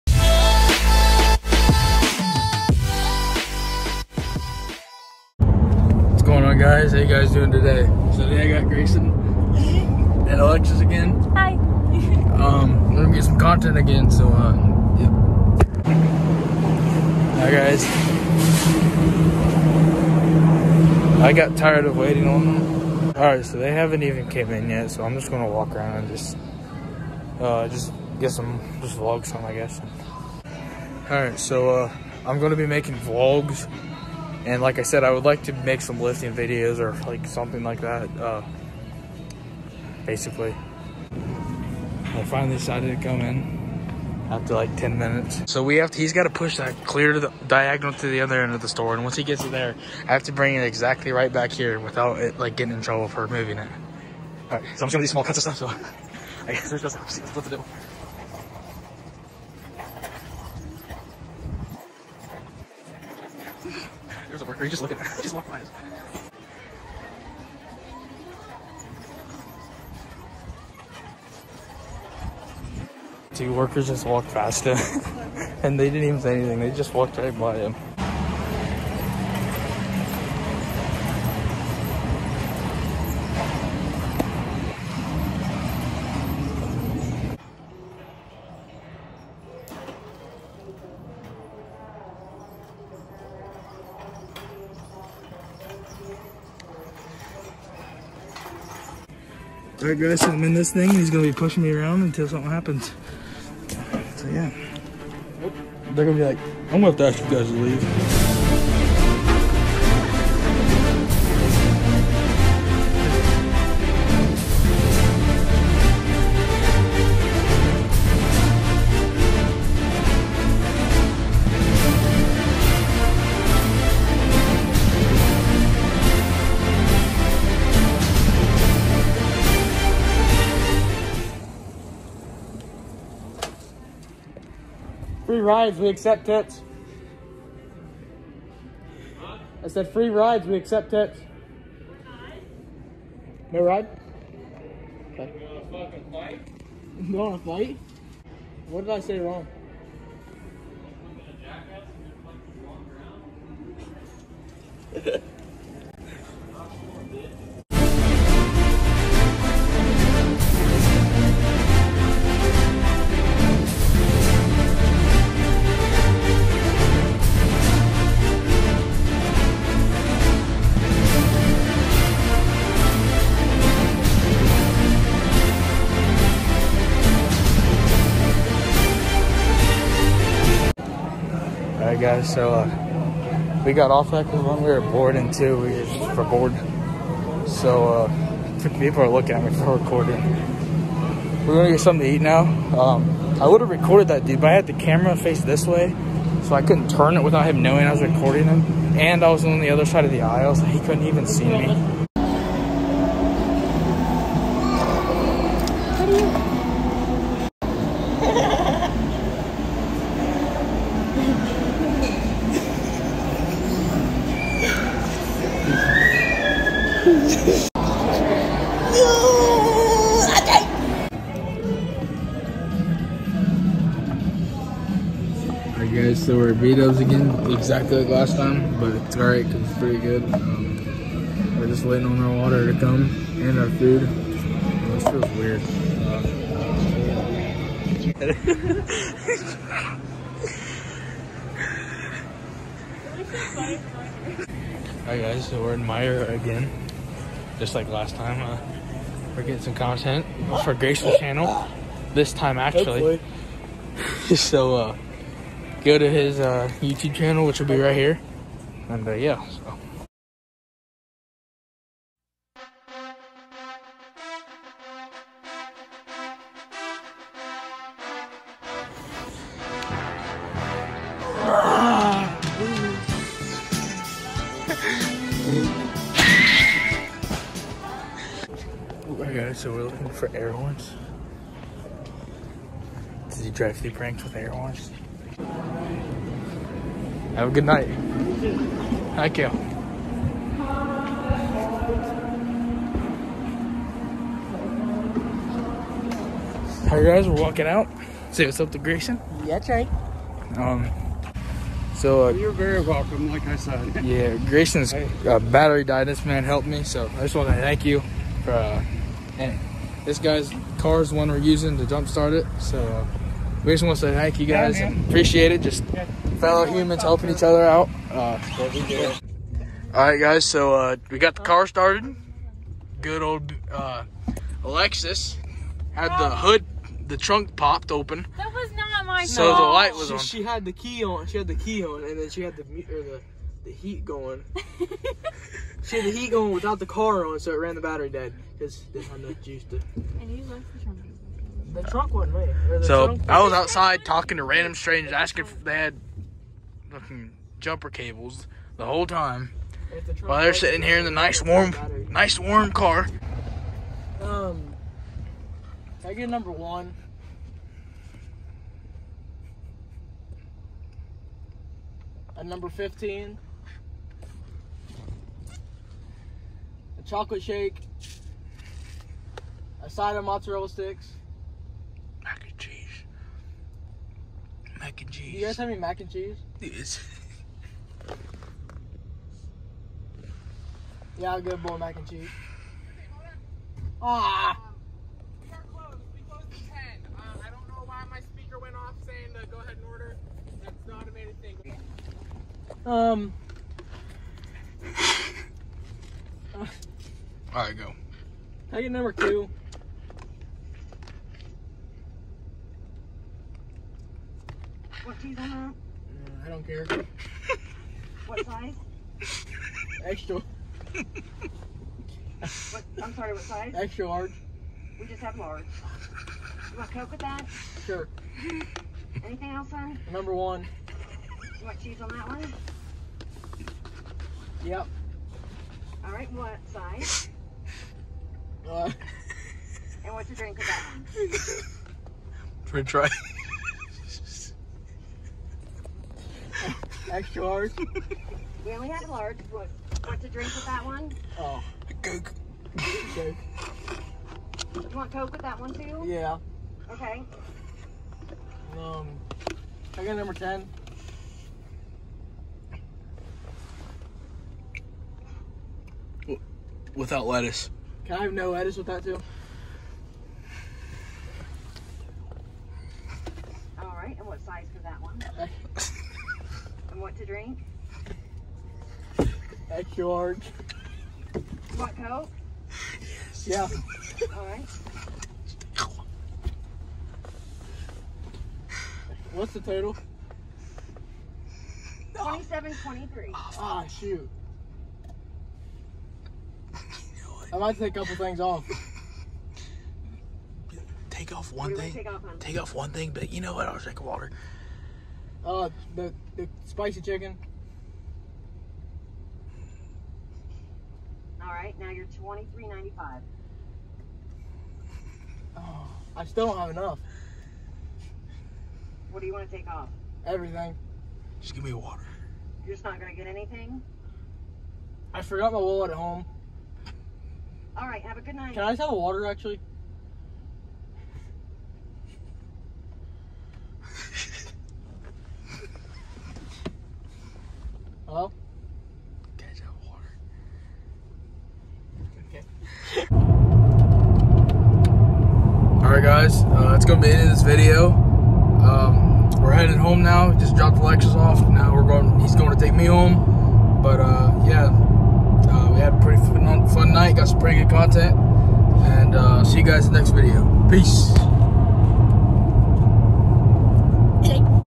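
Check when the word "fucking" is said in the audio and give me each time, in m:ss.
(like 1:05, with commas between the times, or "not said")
2:25, 5:46.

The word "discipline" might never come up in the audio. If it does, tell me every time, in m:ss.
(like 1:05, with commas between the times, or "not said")
not said.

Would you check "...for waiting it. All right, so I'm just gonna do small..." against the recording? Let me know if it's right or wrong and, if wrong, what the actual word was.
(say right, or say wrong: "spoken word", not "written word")
wrong: "moving", not "waiting".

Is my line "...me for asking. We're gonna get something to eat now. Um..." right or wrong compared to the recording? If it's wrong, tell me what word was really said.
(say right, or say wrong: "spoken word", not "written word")
wrong: "recording", not "asking".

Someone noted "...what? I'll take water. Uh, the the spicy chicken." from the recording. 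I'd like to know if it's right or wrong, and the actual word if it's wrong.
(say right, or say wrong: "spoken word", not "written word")
right.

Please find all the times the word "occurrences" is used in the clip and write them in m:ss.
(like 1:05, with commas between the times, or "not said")
not said.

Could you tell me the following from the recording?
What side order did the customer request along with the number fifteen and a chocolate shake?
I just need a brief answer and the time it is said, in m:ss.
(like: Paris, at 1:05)
Mozzarella sticks, at 6:10.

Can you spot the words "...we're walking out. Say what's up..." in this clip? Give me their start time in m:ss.
4:57.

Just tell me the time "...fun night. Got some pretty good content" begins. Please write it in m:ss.
9:06.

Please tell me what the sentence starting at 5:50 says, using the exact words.
The while they're sitting here in the nice warm, nice warm car.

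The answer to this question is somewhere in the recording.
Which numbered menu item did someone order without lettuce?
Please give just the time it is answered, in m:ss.
7:30.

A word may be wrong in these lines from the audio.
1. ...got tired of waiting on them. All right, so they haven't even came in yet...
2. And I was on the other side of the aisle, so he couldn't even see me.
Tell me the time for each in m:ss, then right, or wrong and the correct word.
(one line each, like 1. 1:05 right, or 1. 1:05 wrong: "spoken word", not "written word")
1. 0:21 right
2. 3:18 right.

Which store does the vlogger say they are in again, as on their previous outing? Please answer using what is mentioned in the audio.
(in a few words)
Meijer.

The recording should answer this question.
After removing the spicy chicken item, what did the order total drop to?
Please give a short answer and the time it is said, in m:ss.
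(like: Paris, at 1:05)
23.95, at 8:22.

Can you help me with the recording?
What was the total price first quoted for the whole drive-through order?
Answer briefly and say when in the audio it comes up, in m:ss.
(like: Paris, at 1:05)
27.23, at 8:02.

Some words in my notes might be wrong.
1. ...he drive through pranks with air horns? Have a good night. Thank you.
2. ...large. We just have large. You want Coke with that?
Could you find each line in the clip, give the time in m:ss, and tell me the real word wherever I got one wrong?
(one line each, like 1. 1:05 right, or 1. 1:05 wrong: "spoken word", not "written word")
1. 4:43 right
2. 6:54 right.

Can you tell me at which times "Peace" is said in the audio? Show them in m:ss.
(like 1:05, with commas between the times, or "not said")
9:10.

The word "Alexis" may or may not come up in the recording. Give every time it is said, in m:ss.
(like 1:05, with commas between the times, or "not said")
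0:10, 5:24, 9:00.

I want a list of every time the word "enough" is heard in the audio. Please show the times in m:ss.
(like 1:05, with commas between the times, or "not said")
5:39, 8:26.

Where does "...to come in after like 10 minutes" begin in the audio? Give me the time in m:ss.
0:42.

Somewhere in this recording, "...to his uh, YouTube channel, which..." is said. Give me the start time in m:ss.
4:15.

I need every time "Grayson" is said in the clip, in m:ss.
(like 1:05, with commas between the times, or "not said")
0:08, 4:58, 5:04.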